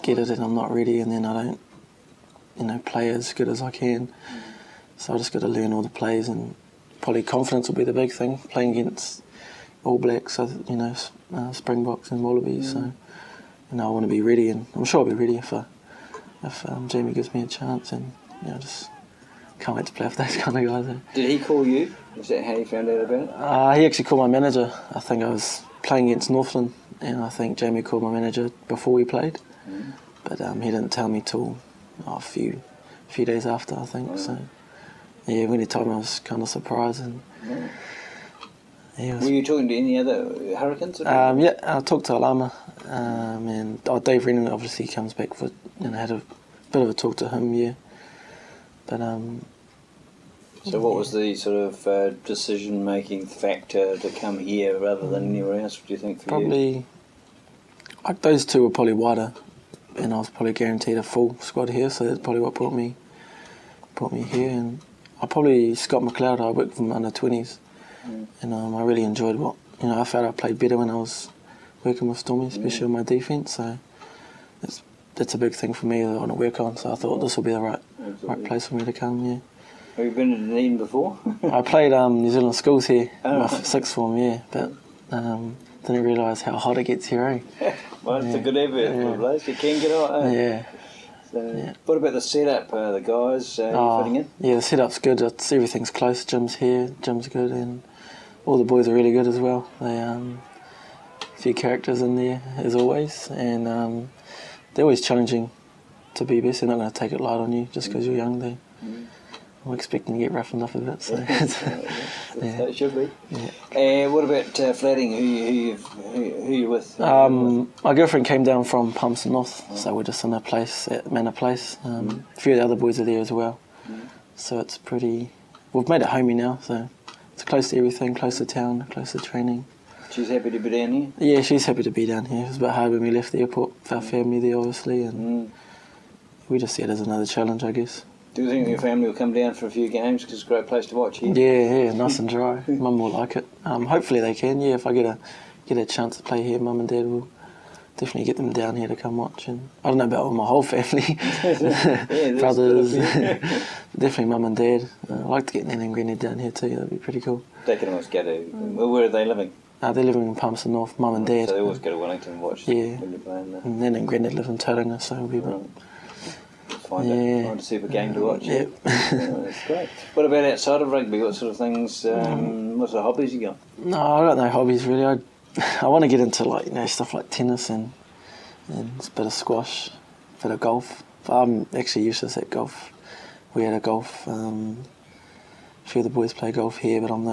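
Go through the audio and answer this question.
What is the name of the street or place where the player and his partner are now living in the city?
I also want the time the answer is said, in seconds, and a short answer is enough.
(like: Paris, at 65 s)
Manor Place, at 121 s.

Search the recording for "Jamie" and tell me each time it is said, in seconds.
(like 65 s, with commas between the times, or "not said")
16 s, 27 s.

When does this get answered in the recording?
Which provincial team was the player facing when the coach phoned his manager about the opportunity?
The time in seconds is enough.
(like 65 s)
26 s.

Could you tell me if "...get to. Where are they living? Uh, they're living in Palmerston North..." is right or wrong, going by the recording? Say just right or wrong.
right.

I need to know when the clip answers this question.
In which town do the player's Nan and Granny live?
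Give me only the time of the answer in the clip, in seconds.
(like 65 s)
164 s.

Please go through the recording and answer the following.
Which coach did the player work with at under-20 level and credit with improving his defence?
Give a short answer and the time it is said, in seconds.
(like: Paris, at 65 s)
Scott McLeod, at 65 s.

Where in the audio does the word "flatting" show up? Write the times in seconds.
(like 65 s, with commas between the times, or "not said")
114 s.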